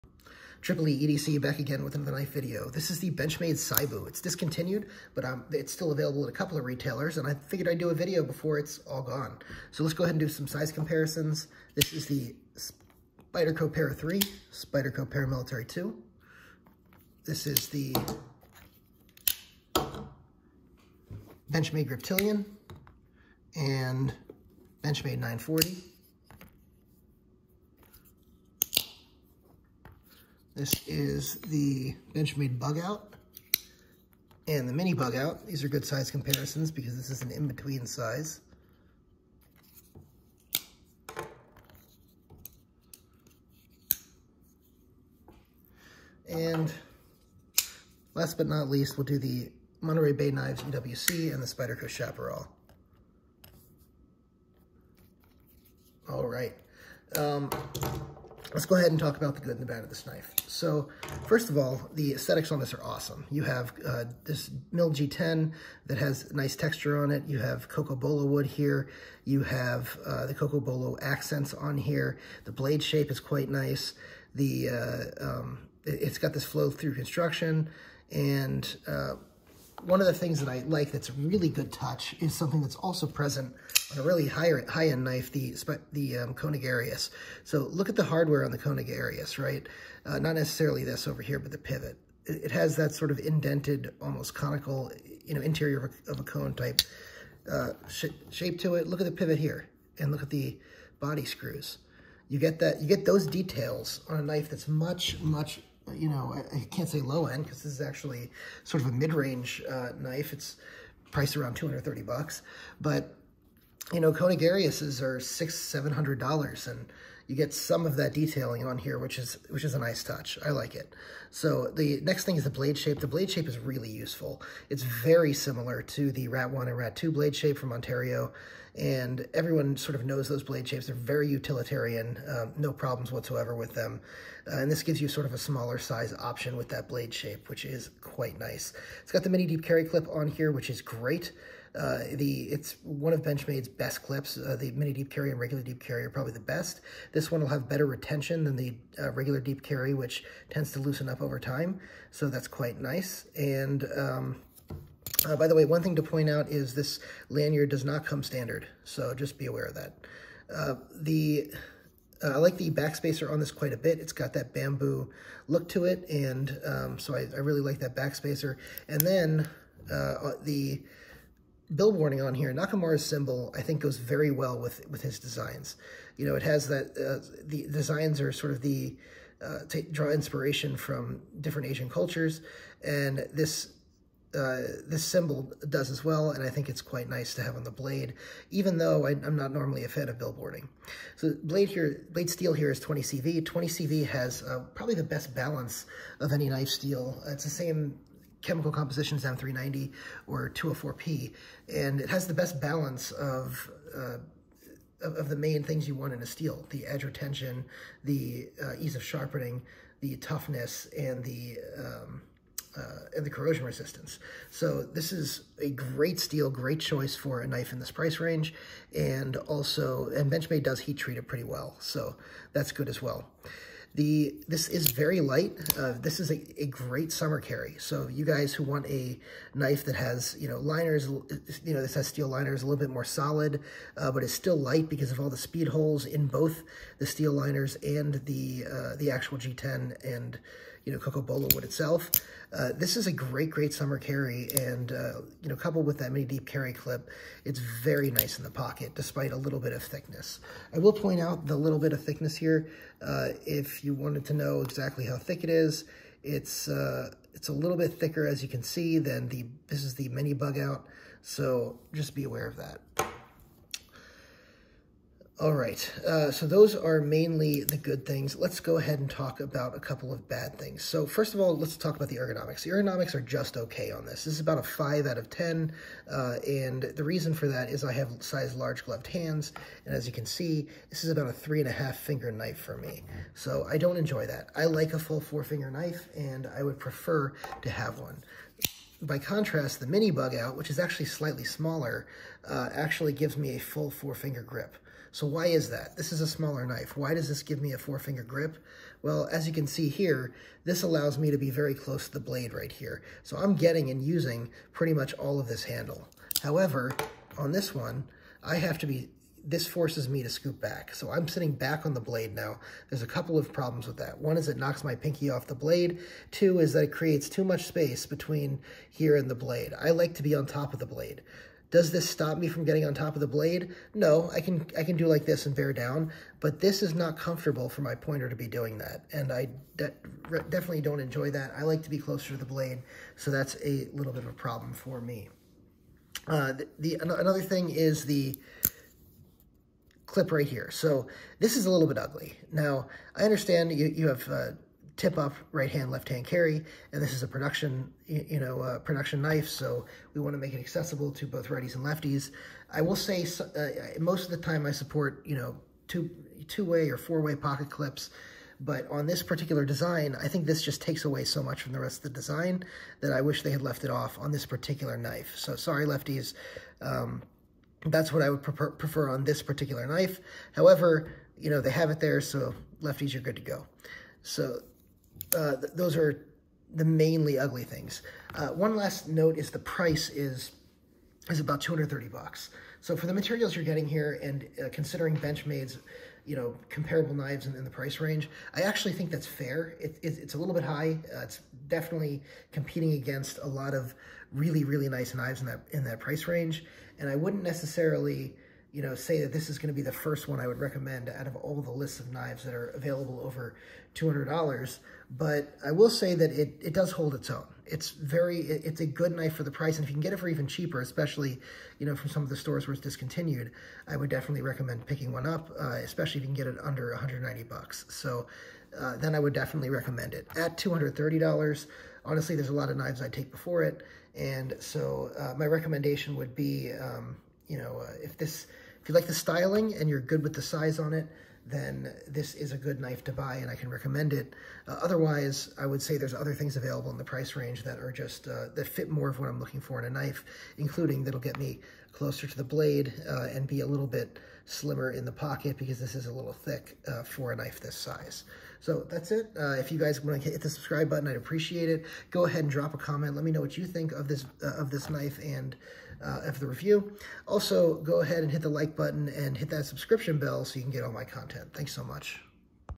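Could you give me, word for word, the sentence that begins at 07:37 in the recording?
Also, go ahead and hit the like button and hit that subscription bell so you can get all my content.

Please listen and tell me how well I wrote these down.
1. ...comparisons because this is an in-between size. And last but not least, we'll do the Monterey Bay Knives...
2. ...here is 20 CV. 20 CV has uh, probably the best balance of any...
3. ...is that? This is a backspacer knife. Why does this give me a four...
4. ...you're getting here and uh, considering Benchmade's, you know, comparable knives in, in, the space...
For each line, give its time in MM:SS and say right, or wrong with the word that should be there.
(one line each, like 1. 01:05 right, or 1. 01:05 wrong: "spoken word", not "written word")
1. 00:36 right
2. 03:12 right
3. 04:55 wrong: "smaller", not "backspacer"
4. 06:23 wrong: "price", not "space".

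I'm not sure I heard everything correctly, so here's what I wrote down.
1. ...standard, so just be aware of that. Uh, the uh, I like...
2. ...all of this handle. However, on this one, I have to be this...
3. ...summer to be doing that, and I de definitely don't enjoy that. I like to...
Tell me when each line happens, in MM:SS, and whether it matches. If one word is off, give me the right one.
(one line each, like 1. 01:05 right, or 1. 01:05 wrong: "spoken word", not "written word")
1. 02:38 right
2. 05:05 right
3. 05:27 wrong: "pointer", not "summer".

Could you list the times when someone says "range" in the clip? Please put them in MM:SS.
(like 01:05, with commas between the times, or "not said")
01:48, 03:38, 06:27, 06:36, 07:17.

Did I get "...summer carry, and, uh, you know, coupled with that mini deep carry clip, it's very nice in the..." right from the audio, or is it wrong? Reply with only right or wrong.
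right.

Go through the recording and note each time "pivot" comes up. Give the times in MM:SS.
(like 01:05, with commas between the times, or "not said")
01:31, 01:39.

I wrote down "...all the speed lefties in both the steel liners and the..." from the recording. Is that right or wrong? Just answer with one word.
wrong.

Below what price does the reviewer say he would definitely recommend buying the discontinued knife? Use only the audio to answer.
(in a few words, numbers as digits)
$190.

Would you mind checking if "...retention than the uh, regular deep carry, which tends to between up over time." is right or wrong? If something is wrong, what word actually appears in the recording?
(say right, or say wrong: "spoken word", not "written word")
wrong: "loosen", not "between".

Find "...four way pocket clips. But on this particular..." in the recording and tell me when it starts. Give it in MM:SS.
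05:56.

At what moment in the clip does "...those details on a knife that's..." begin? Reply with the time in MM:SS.
01:43.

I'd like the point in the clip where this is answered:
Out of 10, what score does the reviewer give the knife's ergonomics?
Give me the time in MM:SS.
04:34.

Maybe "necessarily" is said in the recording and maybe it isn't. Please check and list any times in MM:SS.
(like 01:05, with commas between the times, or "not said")
01:30, 06:37.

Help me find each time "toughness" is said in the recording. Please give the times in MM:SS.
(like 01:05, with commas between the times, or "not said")
03:30.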